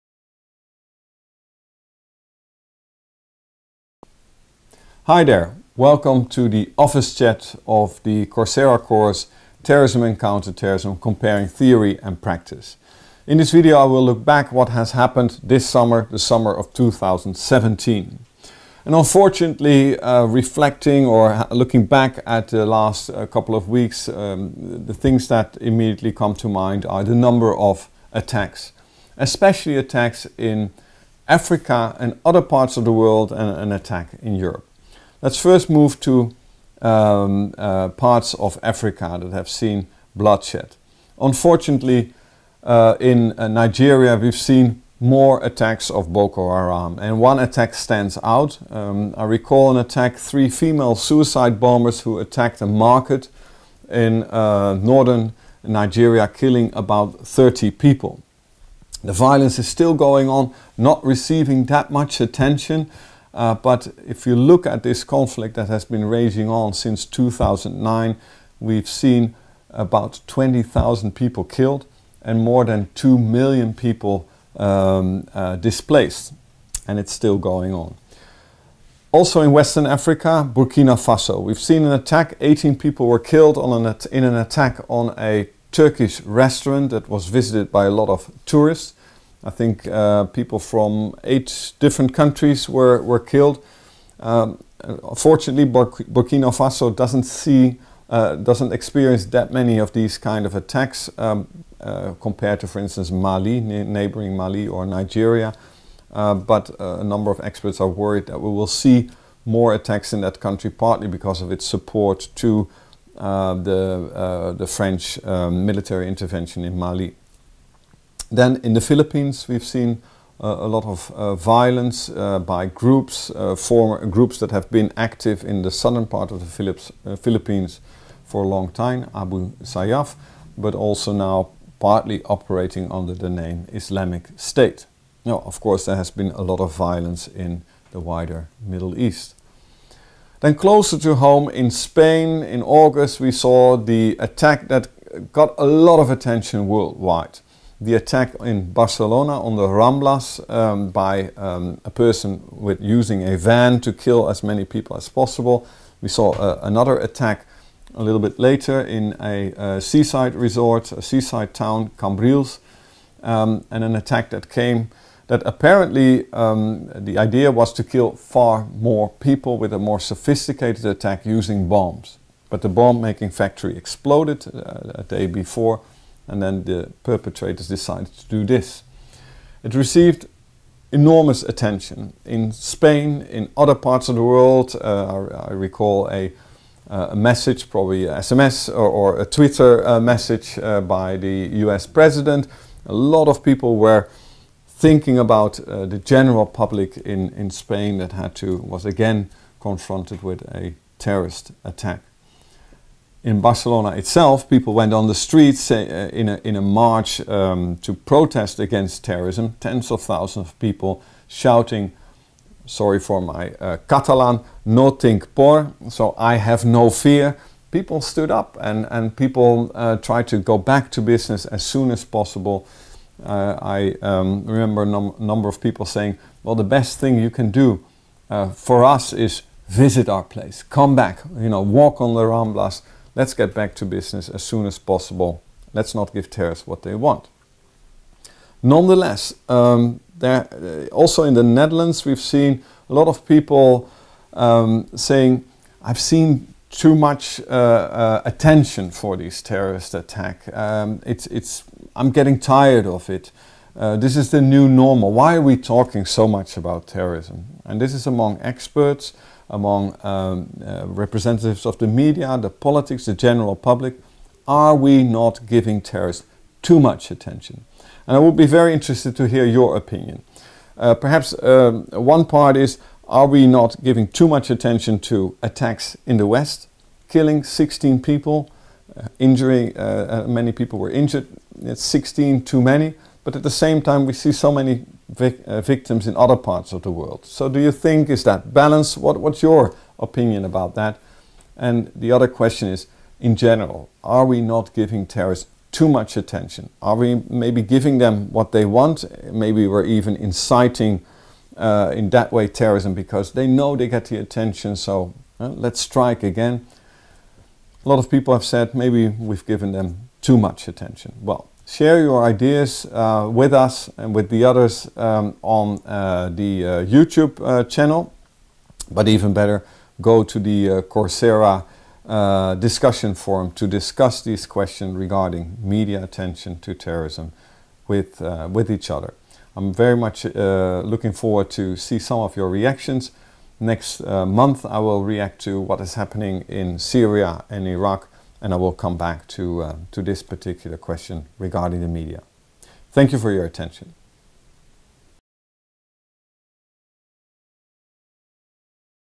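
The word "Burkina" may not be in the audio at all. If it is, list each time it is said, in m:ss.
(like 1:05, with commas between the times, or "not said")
1:20, 1:35.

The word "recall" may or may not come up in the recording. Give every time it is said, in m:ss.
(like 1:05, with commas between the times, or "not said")
0:49, 3:05.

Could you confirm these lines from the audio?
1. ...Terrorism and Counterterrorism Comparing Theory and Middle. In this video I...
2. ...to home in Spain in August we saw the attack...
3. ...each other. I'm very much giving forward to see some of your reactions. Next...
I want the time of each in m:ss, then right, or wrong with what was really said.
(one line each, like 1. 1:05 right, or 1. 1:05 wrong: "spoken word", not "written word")
1. 0:09 wrong: "Practice", not "Middle"
2. 2:20 right
3. 5:28 wrong: "looking", not "giving".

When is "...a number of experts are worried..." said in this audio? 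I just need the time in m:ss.
1:46.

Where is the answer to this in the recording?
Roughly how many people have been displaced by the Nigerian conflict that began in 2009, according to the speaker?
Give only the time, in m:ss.
1:12.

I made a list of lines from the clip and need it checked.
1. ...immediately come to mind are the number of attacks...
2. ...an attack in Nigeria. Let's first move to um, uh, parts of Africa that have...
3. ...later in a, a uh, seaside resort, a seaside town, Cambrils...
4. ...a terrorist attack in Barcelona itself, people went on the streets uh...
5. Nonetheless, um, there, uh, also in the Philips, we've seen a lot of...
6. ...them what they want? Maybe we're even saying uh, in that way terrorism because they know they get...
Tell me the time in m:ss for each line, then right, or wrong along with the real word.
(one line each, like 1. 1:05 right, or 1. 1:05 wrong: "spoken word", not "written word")
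1. 0:25 right
2. 0:33 wrong: "Europe", not "Nigeria"
3. 2:38 right
4. 3:20 right
5. 3:58 wrong: "Netherlands", not "Philips"
6. 4:57 wrong: "inciting", not "saying".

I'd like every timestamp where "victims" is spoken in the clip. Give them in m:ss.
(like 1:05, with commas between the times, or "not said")
4:45.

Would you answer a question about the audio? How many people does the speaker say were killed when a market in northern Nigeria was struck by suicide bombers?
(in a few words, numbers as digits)
30.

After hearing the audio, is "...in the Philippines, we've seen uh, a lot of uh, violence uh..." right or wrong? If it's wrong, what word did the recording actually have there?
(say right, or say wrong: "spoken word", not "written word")
right.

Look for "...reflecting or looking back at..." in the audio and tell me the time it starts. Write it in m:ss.
0:20.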